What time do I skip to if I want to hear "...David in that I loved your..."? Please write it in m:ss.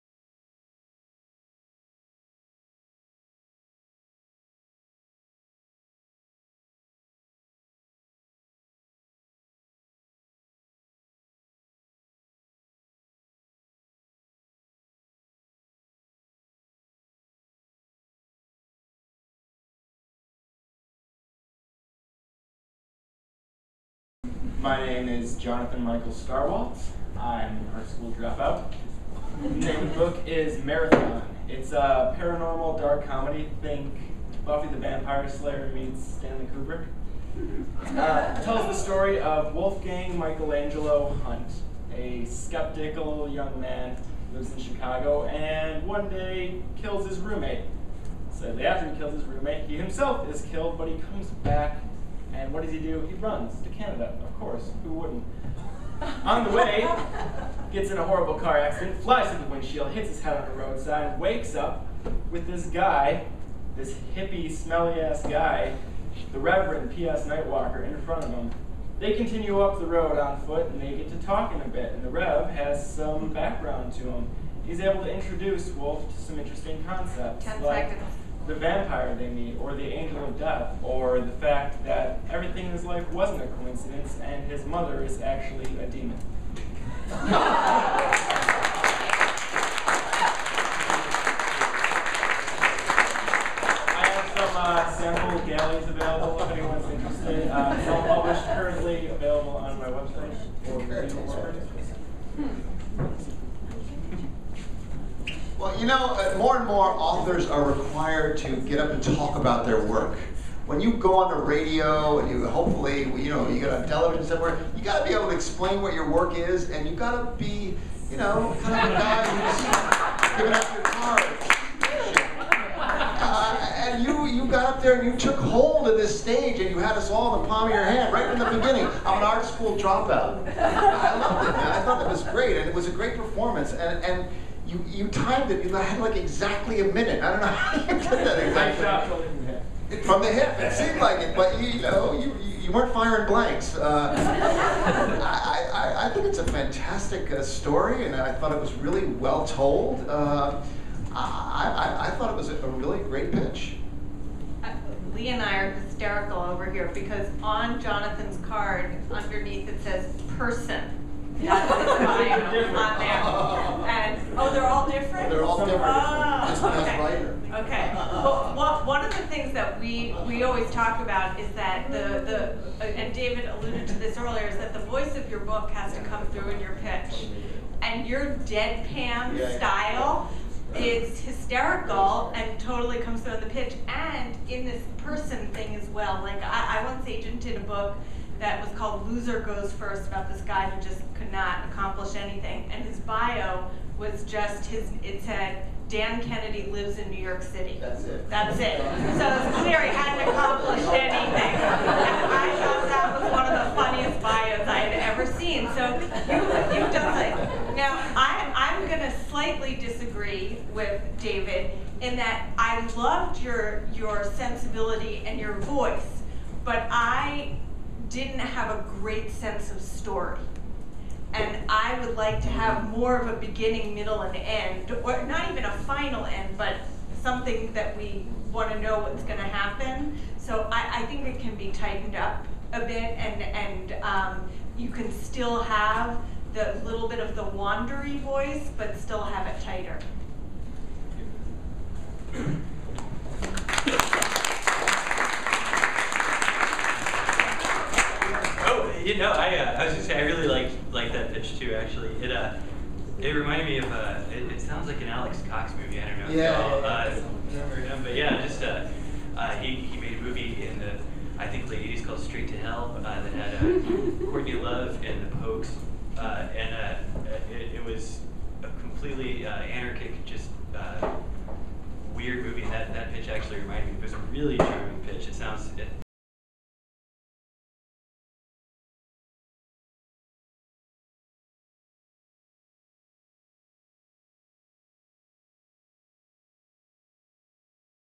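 3:31.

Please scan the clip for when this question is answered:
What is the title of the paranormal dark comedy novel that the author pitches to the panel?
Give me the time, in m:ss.
0:30.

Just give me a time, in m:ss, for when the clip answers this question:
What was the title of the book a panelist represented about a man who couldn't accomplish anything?
3:09.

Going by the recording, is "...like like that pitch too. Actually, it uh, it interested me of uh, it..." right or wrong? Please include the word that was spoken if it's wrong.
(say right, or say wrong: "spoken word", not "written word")
wrong: "reminded", not "interested".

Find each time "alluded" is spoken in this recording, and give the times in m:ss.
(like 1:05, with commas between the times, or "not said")
2:53.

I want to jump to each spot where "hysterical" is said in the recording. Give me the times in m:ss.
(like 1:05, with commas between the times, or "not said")
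2:35, 3:01.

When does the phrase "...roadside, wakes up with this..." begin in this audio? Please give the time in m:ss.
1:00.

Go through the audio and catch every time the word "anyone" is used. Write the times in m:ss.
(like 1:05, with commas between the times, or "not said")
1:36.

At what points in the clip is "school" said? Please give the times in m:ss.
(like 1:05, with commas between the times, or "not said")
0:27, 2:09.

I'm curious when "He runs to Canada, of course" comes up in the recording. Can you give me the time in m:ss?
0:53.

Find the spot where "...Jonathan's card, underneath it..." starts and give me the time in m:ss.
2:37.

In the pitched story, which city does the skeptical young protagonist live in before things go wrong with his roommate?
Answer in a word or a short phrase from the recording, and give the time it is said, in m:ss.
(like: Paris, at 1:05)
Chicago, at 0:44.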